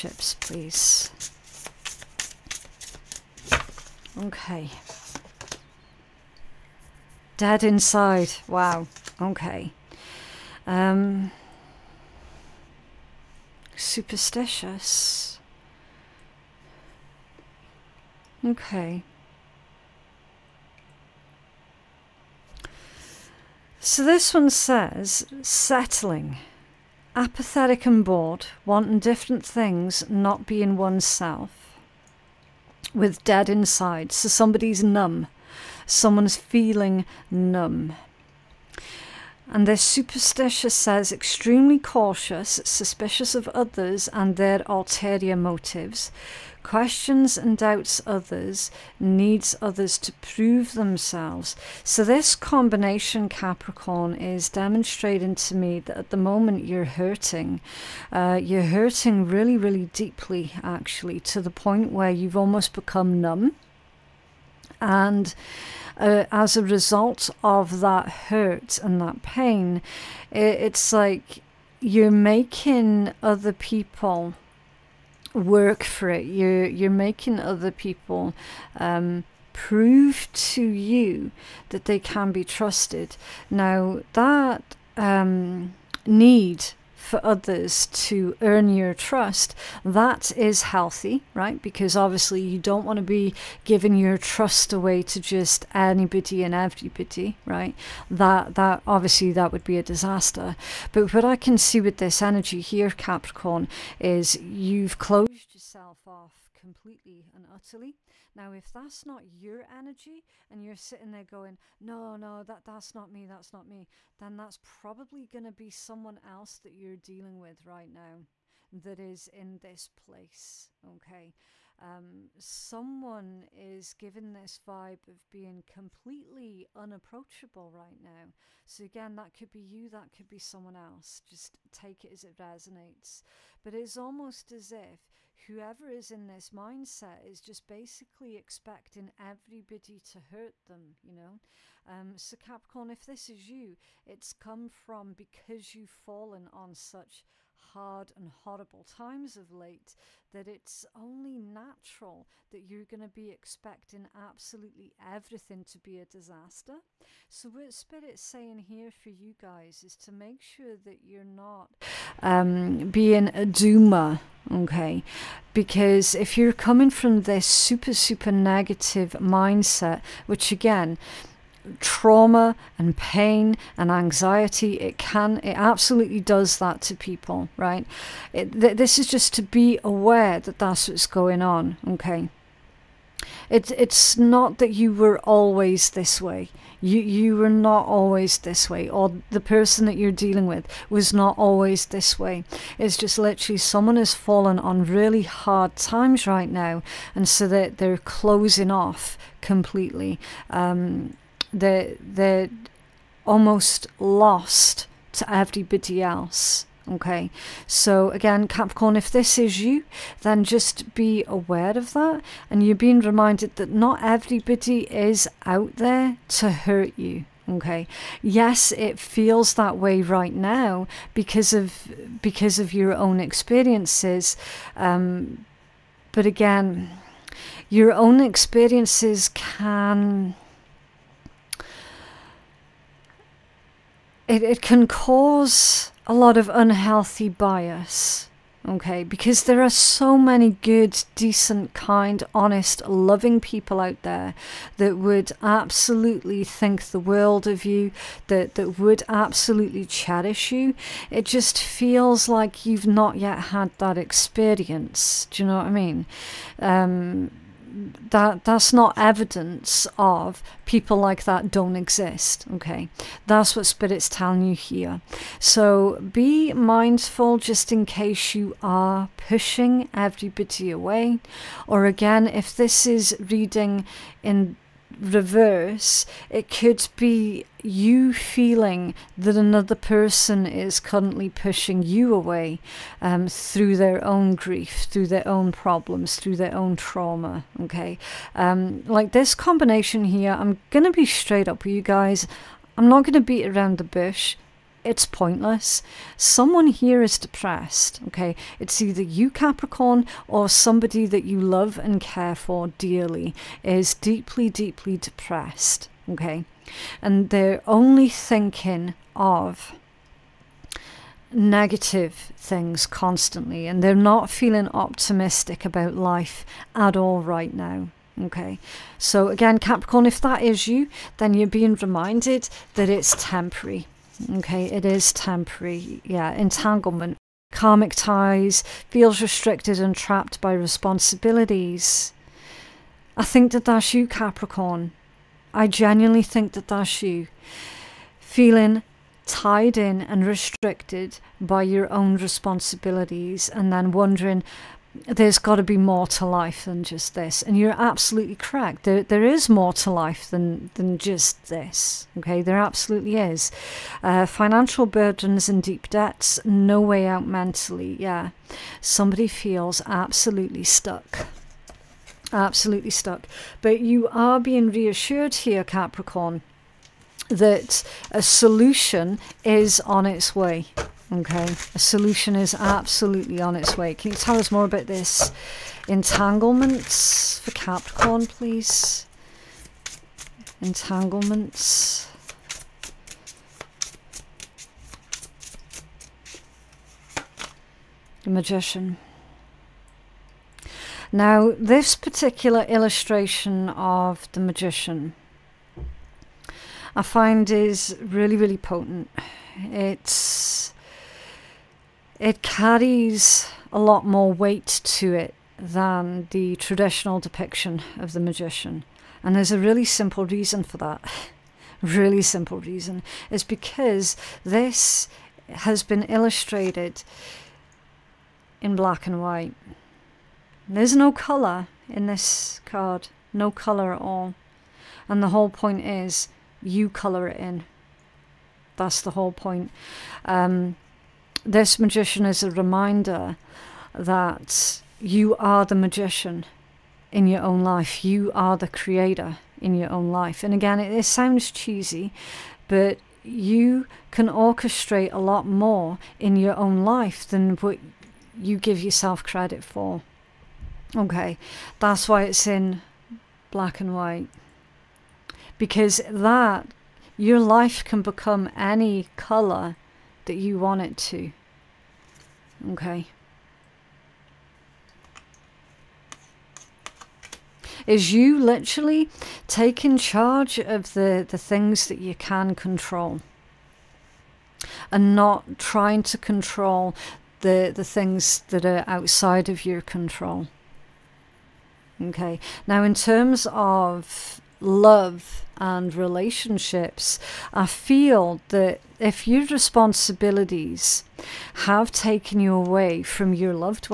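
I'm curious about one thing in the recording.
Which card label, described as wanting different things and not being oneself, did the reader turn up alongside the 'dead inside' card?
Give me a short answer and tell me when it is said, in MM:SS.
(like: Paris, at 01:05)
Settling, at 00:25.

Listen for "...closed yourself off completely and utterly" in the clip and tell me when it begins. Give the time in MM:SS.
01:44.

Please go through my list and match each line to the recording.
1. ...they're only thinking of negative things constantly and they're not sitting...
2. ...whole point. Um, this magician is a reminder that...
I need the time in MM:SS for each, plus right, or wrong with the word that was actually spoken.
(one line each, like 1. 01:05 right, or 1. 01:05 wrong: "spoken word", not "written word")
1. 05:07 wrong: "feeling", not "sitting"
2. 07:09 right.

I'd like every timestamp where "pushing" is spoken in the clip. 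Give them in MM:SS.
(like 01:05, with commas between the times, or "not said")
04:29, 04:41.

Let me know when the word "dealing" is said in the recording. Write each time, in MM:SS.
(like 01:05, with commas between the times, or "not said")
01:57, 03:10.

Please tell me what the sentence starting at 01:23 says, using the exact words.
Now, that um, need for others to earn your trust, that is healthy, right?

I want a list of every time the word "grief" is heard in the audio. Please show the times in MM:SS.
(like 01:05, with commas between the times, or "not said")
04:44.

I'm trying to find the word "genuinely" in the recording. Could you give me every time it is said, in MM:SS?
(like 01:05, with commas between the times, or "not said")
05:35.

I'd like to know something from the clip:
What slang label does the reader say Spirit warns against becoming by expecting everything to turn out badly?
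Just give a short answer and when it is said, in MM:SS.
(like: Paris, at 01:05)
Doomer, at 02:43.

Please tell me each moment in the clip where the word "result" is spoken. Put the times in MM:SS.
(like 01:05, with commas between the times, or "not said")
01:06.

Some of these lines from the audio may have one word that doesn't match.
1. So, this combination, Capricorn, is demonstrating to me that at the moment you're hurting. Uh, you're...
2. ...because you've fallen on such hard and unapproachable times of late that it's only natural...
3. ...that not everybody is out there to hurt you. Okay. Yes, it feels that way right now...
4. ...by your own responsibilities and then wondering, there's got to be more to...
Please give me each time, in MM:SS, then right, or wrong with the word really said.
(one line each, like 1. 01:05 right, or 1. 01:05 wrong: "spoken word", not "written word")
1. 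00:51 right
2. 02:25 wrong: "horrible", not "unapproachable"
3. 03:33 right
4. 05:41 right.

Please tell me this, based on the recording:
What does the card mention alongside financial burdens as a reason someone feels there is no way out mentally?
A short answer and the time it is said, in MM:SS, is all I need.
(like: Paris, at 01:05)
Deep debts, at 05:55.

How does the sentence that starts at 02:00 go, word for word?
Okay, um, someone is given this vibe of being completely unapproachable right now.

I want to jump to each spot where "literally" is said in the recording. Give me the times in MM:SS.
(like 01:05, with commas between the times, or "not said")
03:13, 07:48.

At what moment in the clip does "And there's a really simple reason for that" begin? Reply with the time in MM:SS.
06:49.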